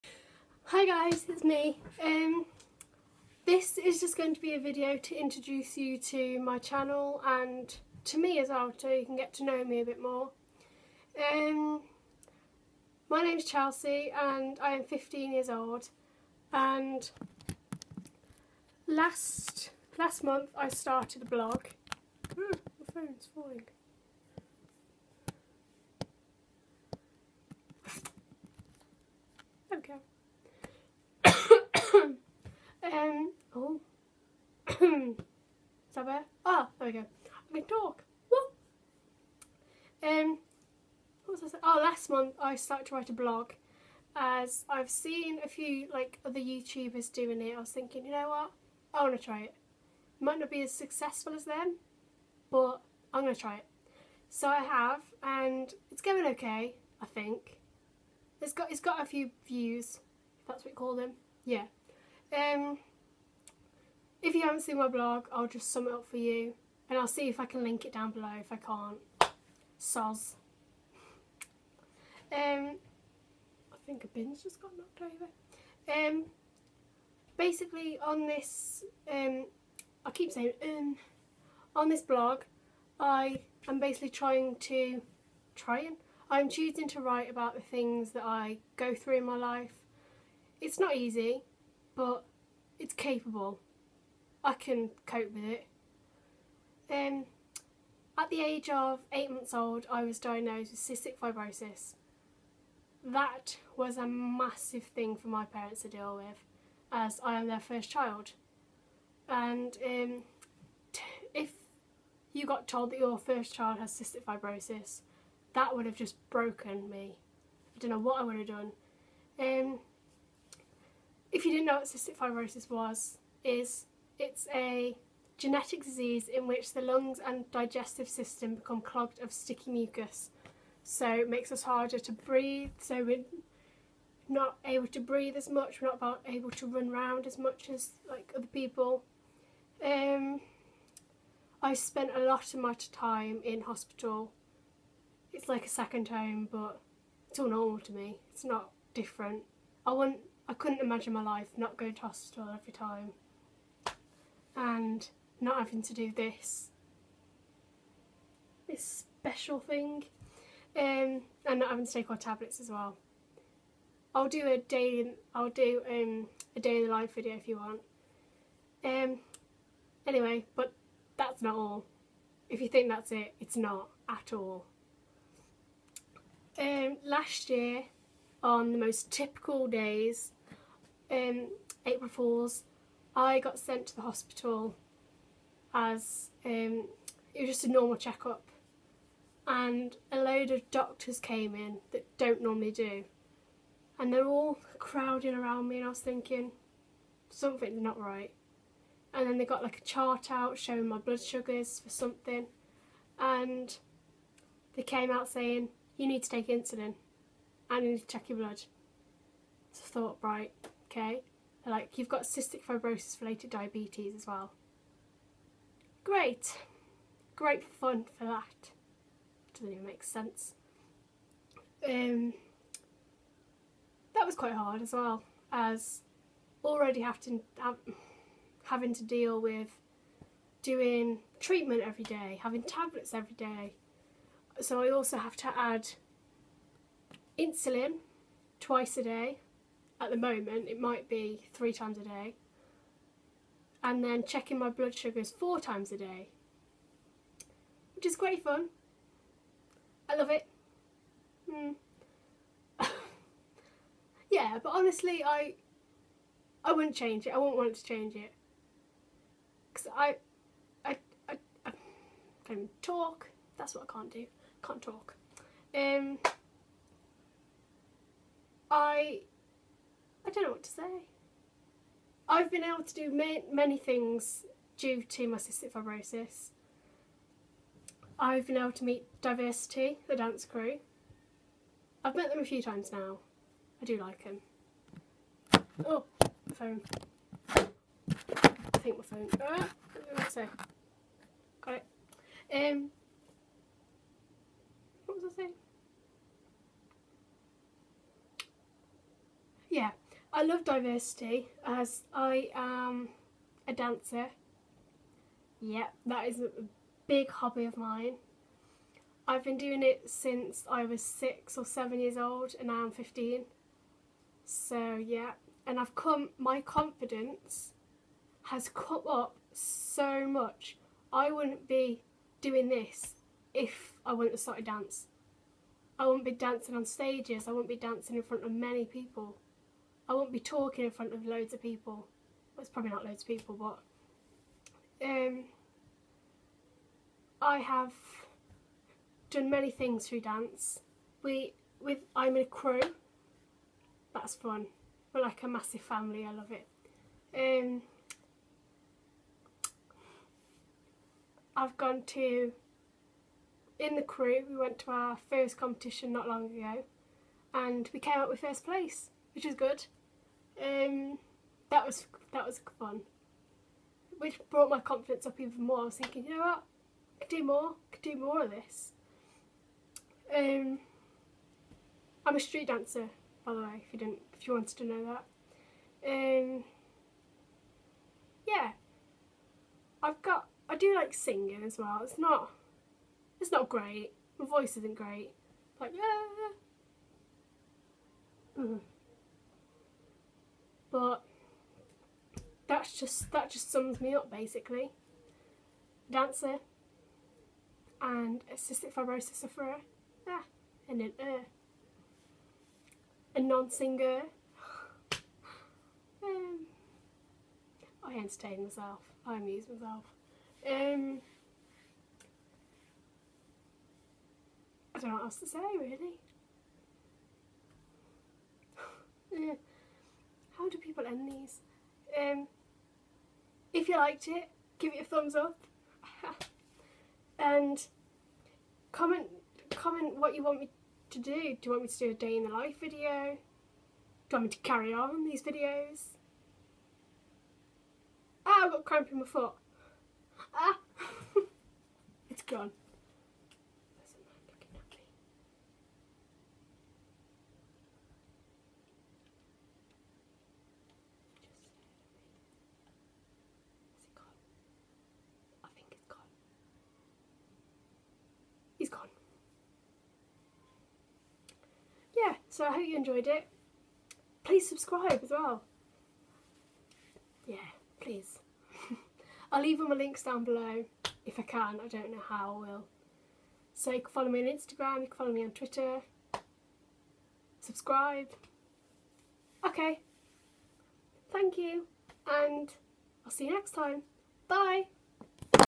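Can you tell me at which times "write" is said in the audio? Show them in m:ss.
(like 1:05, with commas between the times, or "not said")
0:42, 1:27.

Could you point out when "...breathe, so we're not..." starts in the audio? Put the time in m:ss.
2:12.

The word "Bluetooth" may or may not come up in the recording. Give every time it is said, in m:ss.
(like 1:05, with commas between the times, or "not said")
not said.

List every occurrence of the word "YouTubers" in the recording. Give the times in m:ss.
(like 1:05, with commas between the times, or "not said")
0:46.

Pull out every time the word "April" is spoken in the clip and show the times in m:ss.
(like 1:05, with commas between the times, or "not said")
3:01.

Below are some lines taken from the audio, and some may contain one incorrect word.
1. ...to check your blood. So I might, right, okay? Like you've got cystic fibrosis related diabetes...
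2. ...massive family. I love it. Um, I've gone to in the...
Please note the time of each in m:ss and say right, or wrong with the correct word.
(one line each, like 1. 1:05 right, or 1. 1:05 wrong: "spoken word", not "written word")
1. 3:27 wrong: "thought", not "might"
2. 5:45 right.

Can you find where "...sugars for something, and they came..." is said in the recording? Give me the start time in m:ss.
3:21.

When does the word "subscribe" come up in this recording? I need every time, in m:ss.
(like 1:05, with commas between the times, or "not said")
7:44, 7:57.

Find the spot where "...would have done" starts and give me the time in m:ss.
1:58.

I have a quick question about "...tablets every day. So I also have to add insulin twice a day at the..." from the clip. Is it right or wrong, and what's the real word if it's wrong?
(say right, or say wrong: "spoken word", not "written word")
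right.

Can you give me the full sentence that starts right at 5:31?
Well, it's probably not loads of people, but um, I have done many things through dance.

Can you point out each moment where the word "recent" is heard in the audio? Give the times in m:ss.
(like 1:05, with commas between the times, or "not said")
not said.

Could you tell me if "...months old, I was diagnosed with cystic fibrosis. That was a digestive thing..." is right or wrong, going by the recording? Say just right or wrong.
wrong.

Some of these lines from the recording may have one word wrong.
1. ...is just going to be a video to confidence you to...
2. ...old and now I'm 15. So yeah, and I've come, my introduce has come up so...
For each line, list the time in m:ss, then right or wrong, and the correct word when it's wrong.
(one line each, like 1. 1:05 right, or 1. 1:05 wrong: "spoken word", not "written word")
1. 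0:03 wrong: "introduce", not "confidence"
2. 5:12 wrong: "confidence", not "introduce".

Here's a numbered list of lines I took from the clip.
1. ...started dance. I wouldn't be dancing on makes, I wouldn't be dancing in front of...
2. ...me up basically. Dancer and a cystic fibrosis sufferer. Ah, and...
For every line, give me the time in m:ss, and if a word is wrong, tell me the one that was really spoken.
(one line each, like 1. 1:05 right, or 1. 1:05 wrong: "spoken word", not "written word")
1. 5:24 wrong: "stages", not "makes"
2. 6:34 right.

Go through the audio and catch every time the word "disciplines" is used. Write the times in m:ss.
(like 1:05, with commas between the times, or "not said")
not said.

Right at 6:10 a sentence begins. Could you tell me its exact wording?
Um, I'm a street dancer, by the way, if you didn't, if you wanted to know that.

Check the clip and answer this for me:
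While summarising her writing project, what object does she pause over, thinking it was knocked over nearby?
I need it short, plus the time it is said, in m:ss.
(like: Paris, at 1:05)
A bin, at 1:14.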